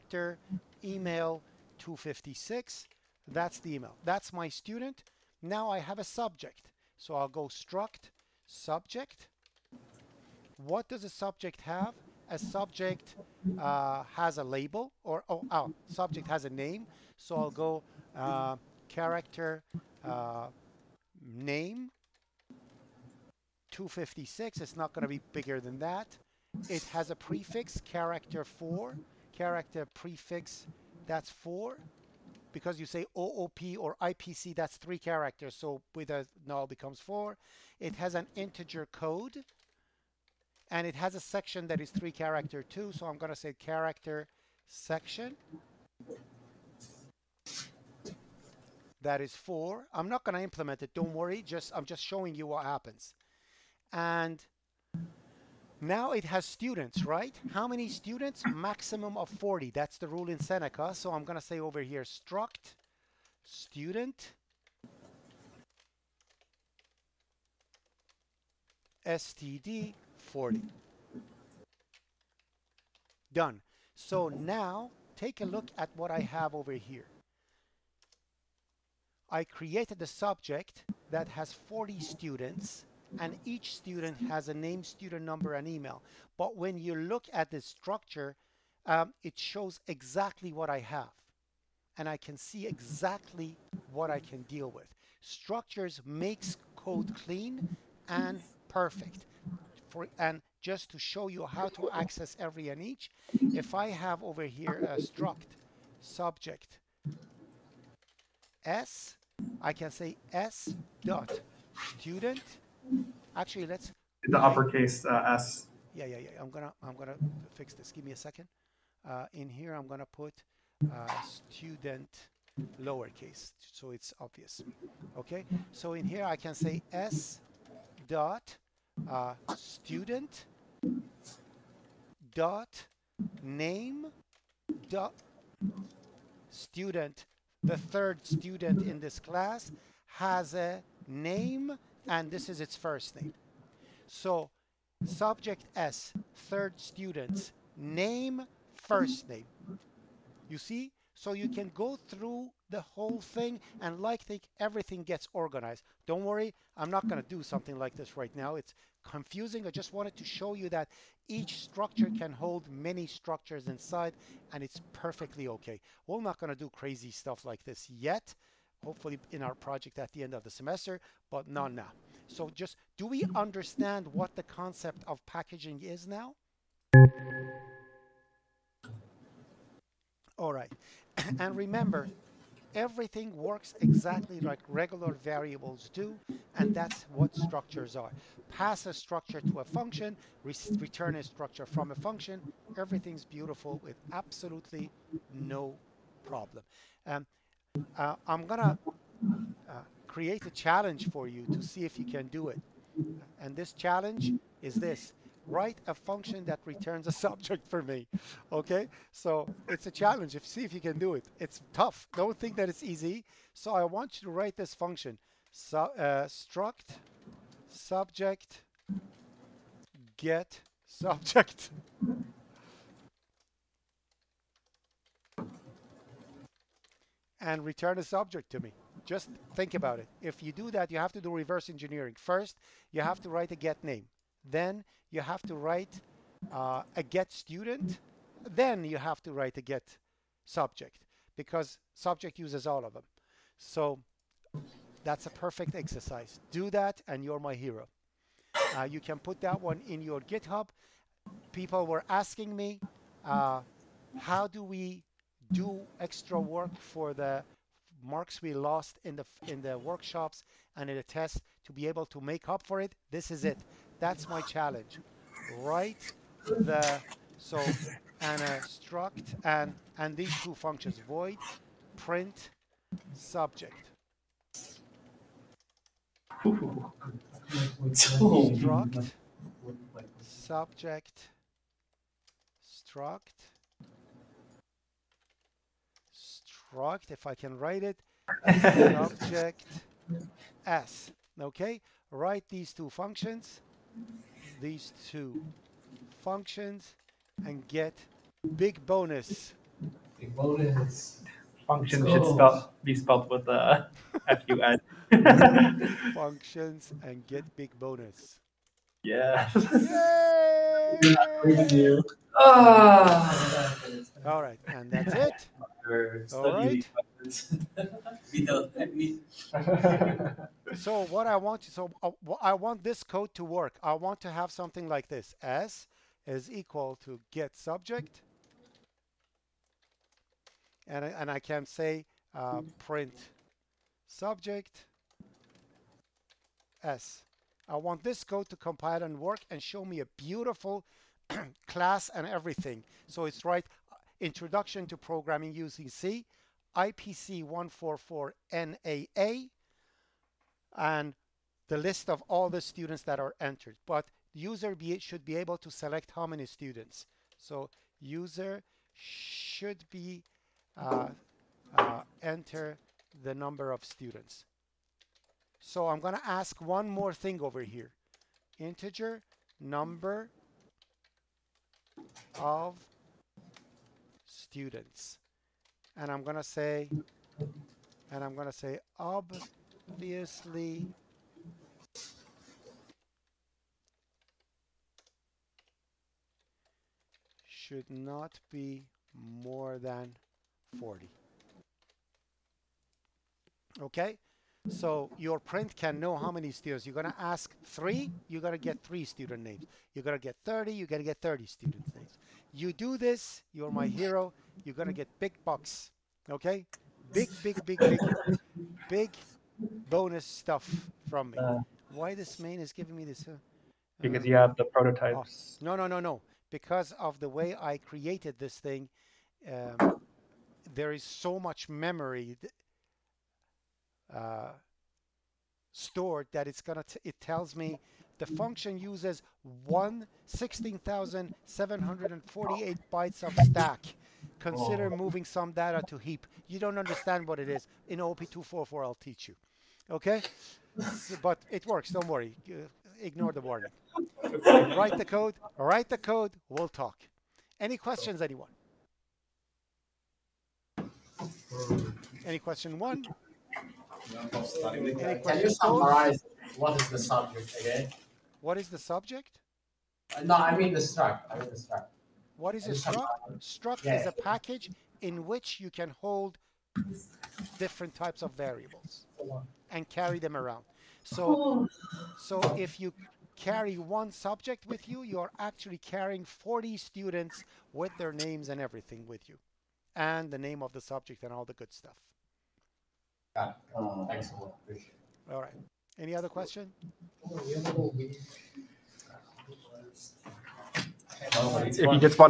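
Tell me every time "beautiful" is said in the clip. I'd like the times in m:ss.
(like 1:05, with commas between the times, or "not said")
3:13, 5:40.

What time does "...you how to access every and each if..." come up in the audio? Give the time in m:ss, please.
1:41.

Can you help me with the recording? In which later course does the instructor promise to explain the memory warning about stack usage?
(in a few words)
OOP244.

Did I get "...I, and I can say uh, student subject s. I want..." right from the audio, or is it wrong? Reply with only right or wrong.
wrong.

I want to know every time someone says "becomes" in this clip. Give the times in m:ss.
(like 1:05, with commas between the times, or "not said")
0:36.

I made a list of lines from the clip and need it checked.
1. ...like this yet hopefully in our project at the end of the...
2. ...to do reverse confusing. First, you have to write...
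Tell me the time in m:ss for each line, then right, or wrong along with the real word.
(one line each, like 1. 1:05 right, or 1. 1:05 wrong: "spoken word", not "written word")
1. 2:47 right
2. 3:51 wrong: "engineering", not "confusing".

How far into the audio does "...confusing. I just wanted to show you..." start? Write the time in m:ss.
2:39.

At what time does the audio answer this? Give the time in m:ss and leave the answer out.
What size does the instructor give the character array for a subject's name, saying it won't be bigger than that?
0:21.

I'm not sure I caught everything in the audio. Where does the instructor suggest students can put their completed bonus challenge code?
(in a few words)
GitHub.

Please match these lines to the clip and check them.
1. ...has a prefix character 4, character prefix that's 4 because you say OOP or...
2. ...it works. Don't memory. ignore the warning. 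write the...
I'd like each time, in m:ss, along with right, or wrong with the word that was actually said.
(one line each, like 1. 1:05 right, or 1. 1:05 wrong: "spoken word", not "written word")
1. 0:26 right
2. 7:21 wrong: "worry", not "memory".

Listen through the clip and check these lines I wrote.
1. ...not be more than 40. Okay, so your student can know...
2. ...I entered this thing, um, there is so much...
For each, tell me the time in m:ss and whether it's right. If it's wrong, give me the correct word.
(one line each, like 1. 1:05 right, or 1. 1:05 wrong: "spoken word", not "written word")
1. 6:27 wrong: "print", not "student"
2. 6:57 wrong: "created", not "entered".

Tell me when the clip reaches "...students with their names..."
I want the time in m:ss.
7:56.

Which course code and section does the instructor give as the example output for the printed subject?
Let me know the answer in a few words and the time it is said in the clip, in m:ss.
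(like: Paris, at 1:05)
IPC 144 NAA, at 5:46.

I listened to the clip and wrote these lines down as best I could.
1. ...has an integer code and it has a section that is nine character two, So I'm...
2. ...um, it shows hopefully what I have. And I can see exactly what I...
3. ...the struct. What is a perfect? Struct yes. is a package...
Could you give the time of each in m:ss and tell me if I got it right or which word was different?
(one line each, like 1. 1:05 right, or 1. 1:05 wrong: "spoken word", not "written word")
1. 0:37 wrong: "three", not "nine"
2. 1:28 wrong: "exactly", not "hopefully"
3. 7:41 wrong: "struct", not "perfect".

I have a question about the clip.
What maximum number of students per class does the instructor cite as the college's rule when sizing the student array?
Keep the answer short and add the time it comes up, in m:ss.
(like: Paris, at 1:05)
40, at 0:58.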